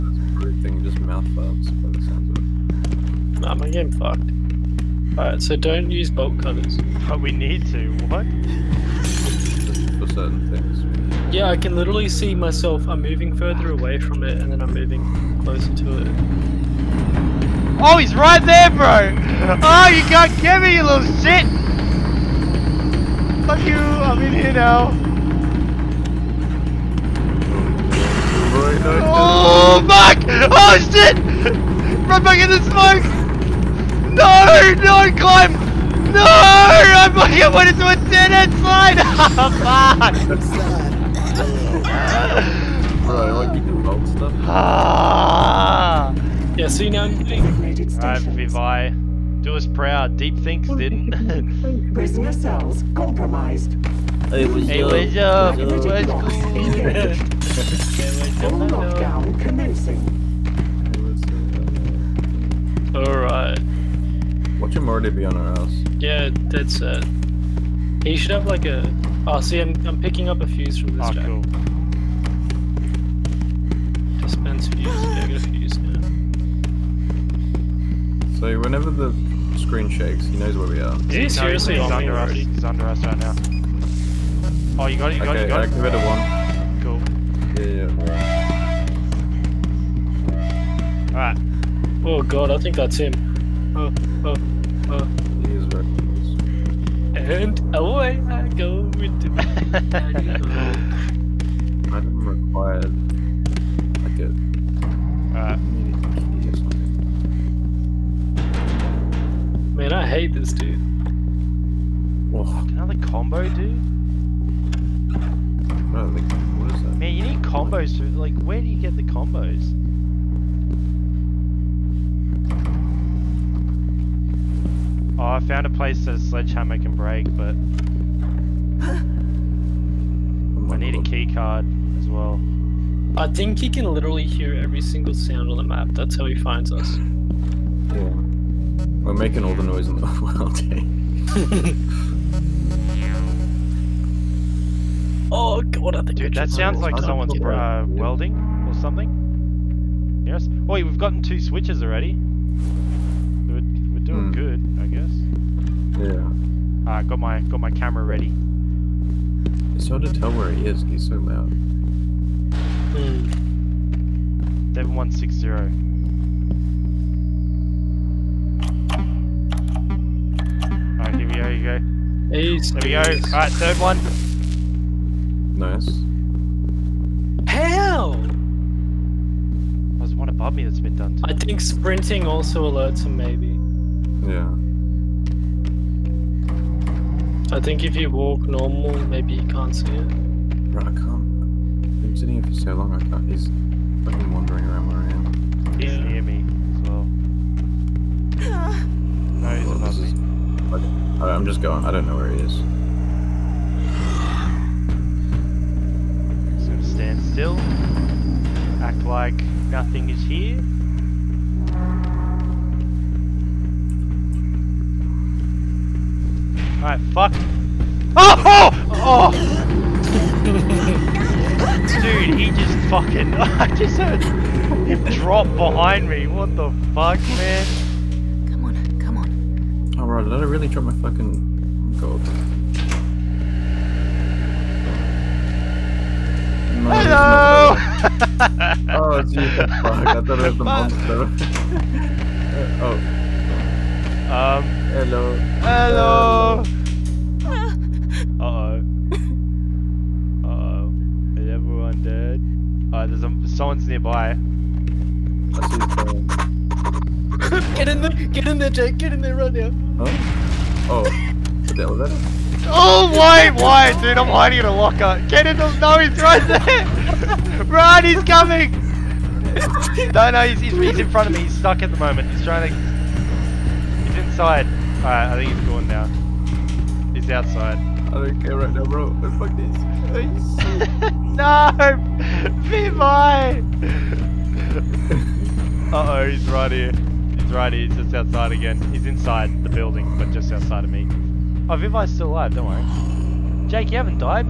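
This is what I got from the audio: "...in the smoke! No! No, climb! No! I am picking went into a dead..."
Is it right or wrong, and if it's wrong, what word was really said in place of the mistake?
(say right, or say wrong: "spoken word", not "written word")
wrong: "fucking", not "picking".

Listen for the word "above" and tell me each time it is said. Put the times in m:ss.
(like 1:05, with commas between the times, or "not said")
3:00, 3:19.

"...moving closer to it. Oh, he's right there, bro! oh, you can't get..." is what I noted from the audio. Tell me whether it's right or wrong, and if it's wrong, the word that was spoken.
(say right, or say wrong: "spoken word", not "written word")
right.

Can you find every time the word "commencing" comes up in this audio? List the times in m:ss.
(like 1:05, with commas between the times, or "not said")
0:59.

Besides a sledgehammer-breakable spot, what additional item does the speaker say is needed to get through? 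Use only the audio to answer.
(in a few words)
key card.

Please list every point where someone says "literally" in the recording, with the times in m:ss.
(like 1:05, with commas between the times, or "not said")
0:11, 2:13.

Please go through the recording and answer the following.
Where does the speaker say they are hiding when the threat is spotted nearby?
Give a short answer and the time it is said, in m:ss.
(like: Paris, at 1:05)
a locker, at 4:24.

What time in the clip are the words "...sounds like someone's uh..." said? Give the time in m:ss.
2:26.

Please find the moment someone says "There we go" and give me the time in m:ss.
2:52.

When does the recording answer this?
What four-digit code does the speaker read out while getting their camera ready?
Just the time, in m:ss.
2:44.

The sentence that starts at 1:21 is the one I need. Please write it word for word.
Is he seriously he's on under us?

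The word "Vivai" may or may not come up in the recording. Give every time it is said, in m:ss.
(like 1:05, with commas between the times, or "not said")
0:48, 4:51.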